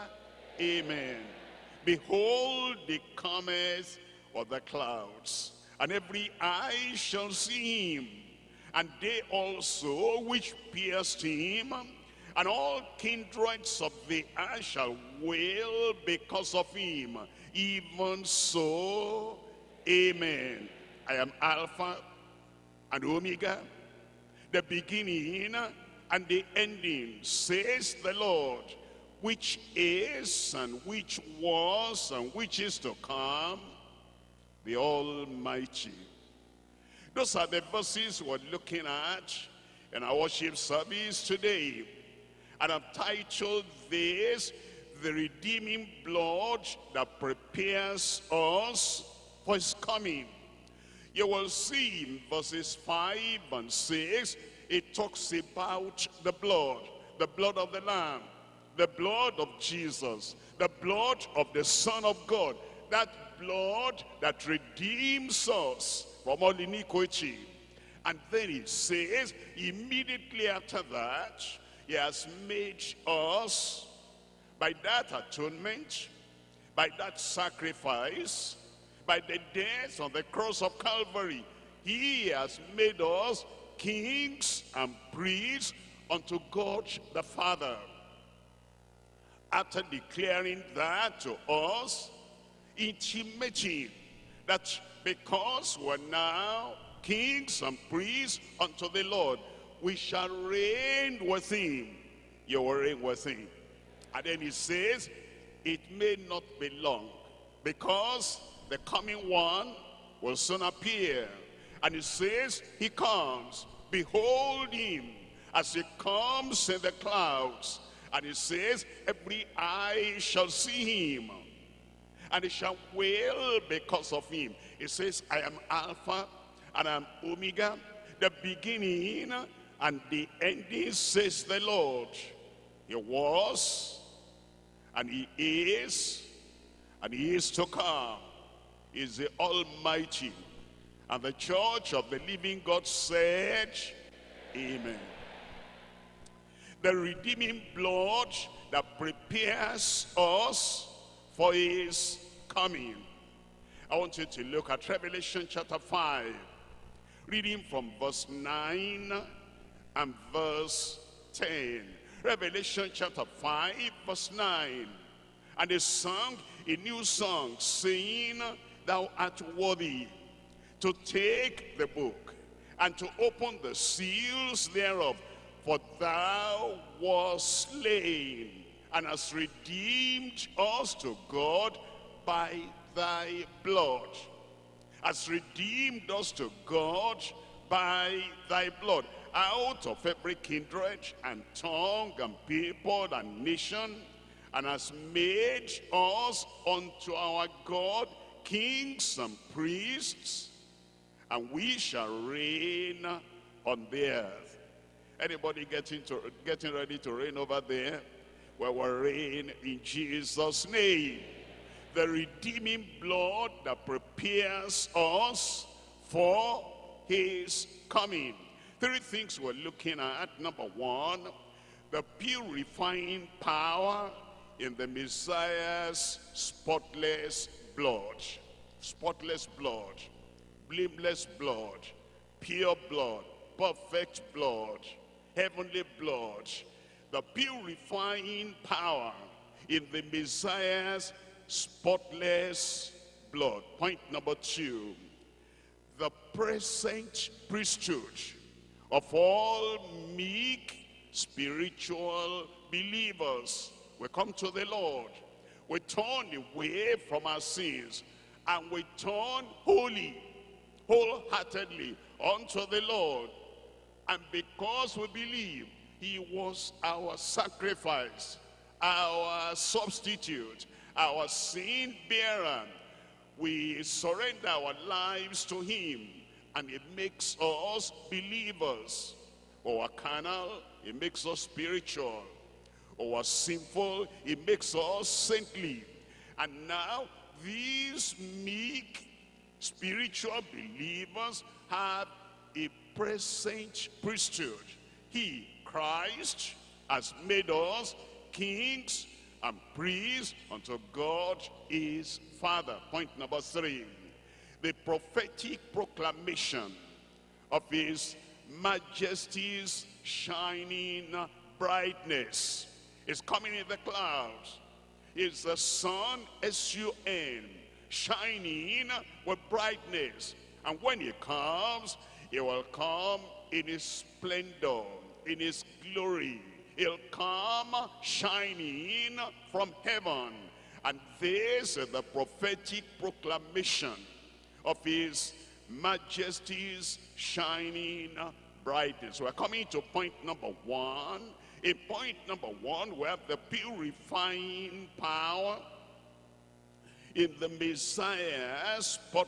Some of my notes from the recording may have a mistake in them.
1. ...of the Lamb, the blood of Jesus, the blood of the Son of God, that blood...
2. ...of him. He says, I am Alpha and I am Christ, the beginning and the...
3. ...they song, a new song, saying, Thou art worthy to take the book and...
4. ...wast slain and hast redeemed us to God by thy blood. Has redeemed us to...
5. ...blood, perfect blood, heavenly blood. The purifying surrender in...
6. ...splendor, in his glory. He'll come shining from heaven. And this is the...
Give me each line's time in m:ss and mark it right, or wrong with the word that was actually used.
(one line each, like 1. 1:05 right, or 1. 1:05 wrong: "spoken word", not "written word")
1. 0:57 right
2. 2:04 wrong: "Omega", not "Christ"
3. 2:45 right
4. 2:57 right
5. 3:52 wrong: "power", not "surrender"
6. 5:23 right.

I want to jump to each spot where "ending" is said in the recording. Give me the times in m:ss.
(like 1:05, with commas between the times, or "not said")
0:26, 2:10.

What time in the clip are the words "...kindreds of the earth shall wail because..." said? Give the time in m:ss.
0:12.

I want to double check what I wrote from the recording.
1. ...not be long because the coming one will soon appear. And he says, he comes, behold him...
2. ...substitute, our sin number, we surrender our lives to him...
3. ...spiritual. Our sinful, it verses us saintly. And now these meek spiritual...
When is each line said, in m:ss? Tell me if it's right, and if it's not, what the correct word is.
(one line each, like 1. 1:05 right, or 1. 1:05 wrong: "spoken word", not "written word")
1. 1:46 right
2. 4:29 wrong: "bearer", not "number"
3. 4:41 wrong: "makes", not "verses".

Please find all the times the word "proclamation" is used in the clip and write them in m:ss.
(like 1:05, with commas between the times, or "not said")
5:05, 5:32.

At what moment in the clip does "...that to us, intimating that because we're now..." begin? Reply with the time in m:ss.
1:30.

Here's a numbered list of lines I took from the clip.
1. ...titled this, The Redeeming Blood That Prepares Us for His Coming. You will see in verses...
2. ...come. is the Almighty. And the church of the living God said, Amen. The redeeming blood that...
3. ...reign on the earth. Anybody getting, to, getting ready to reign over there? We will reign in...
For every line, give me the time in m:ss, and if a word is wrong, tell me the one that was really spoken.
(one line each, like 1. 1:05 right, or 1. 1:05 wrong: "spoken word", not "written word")
1. 0:42 right
2. 2:17 right
3. 3:22 right.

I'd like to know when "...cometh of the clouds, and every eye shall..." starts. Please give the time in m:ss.
0:03.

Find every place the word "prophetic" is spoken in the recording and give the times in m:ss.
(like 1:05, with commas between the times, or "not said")
5:04, 5:32.